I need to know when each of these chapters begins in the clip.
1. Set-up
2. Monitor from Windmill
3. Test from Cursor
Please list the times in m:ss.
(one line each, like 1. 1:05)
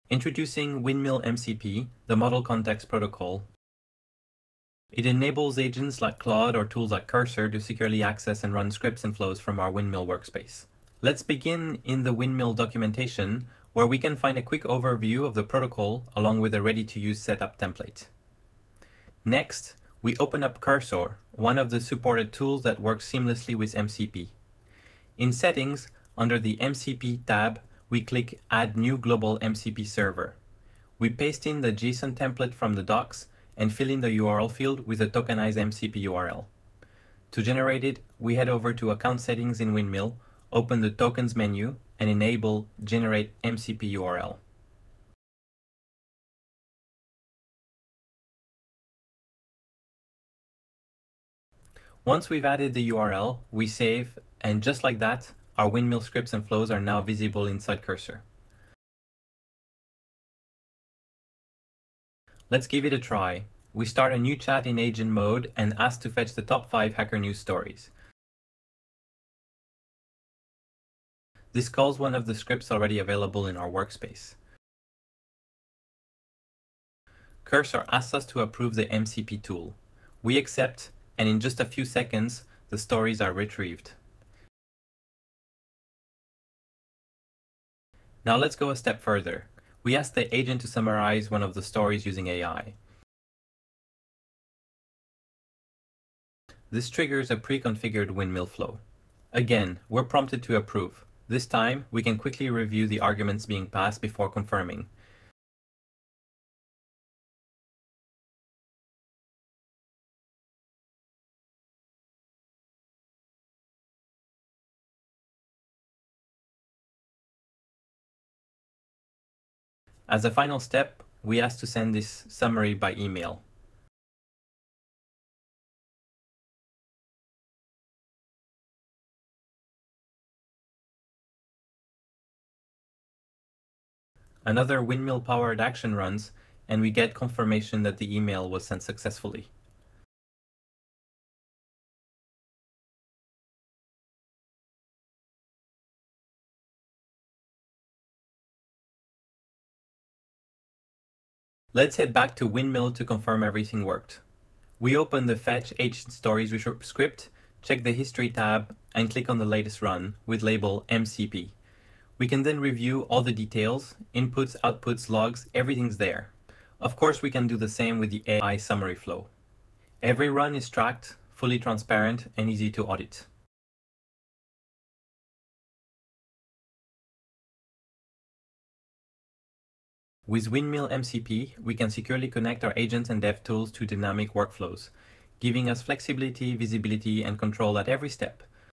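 1. 0:18
2. 2:34
3. 1:01.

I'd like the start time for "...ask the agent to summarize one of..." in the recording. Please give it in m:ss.
1:29.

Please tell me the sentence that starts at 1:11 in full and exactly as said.
This calls one of the scripts already available in our workspace.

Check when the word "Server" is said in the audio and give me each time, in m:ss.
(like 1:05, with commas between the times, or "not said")
0:29.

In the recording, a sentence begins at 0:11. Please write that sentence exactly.
Let's begin in the Windmill documentation, where we can find a quick overview of the protocol along with a ready-to-use setup template.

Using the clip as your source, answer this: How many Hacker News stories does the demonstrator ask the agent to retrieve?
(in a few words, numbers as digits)
5.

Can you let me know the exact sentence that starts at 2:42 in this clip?
We can then review all the details, inputs, outputs, logs, everything's there.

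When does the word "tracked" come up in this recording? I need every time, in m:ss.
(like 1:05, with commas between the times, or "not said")
2:50.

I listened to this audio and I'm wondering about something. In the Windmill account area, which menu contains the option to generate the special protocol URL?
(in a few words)
Tokens.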